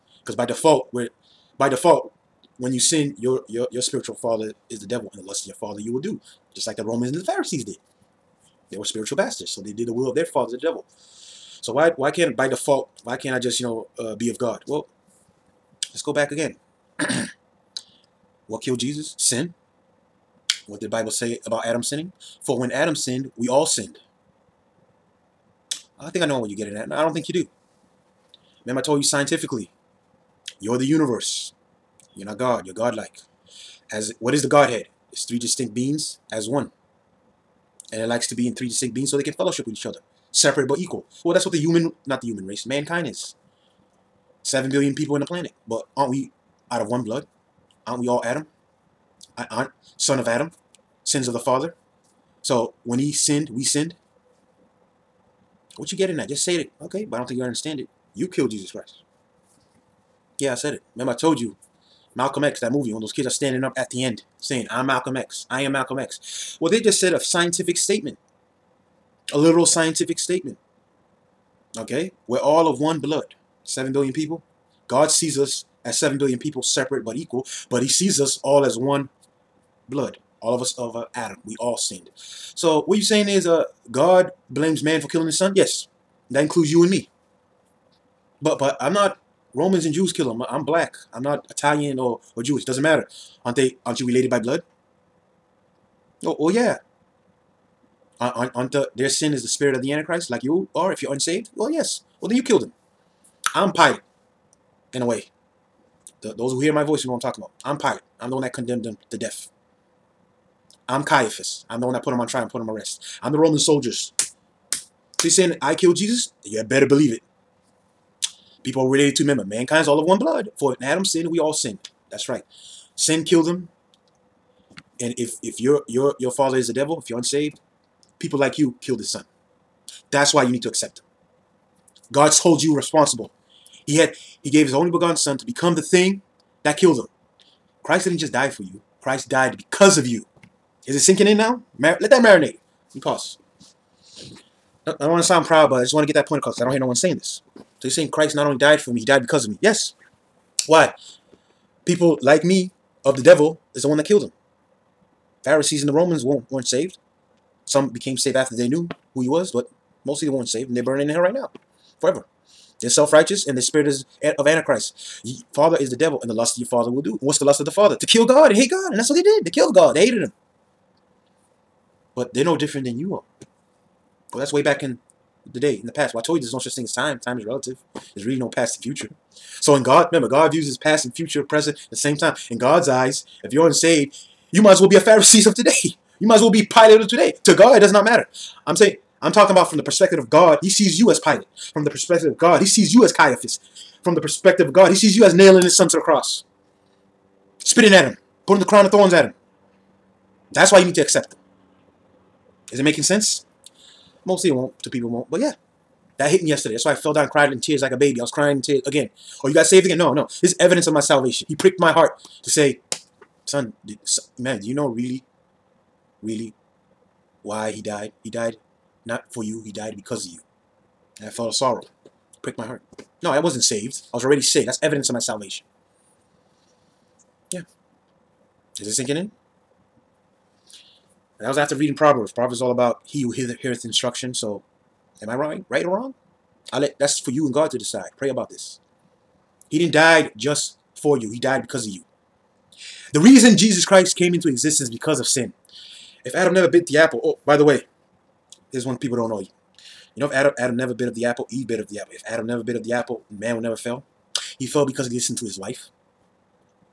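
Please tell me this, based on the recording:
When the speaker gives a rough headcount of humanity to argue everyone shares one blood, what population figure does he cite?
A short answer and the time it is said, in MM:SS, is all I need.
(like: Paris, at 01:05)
7 billion, at 00:44.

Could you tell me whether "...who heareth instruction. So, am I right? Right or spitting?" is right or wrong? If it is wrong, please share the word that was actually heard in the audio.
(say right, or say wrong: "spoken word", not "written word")
wrong: "wrong", not "spitting".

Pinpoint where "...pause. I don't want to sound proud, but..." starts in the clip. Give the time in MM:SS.
02:22.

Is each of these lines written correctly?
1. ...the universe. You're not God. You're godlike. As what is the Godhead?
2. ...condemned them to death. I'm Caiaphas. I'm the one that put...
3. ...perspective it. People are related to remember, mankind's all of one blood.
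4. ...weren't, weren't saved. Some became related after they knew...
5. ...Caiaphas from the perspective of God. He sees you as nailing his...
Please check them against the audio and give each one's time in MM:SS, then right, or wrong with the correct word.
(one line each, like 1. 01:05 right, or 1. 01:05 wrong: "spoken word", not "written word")
1. 00:30 right
2. 01:48 right
3. 01:56 wrong: "believe", not "perspective"
4. 02:36 wrong: "saved", not "related"
5. 03:13 right.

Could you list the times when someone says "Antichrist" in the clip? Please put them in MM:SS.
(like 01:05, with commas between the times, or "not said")
01:39, 02:44.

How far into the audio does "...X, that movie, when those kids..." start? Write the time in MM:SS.
01:02.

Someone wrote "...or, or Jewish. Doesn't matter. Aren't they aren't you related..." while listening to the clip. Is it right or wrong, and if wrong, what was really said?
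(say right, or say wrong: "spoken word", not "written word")
right.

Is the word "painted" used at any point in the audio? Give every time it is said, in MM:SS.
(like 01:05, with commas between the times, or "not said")
not said.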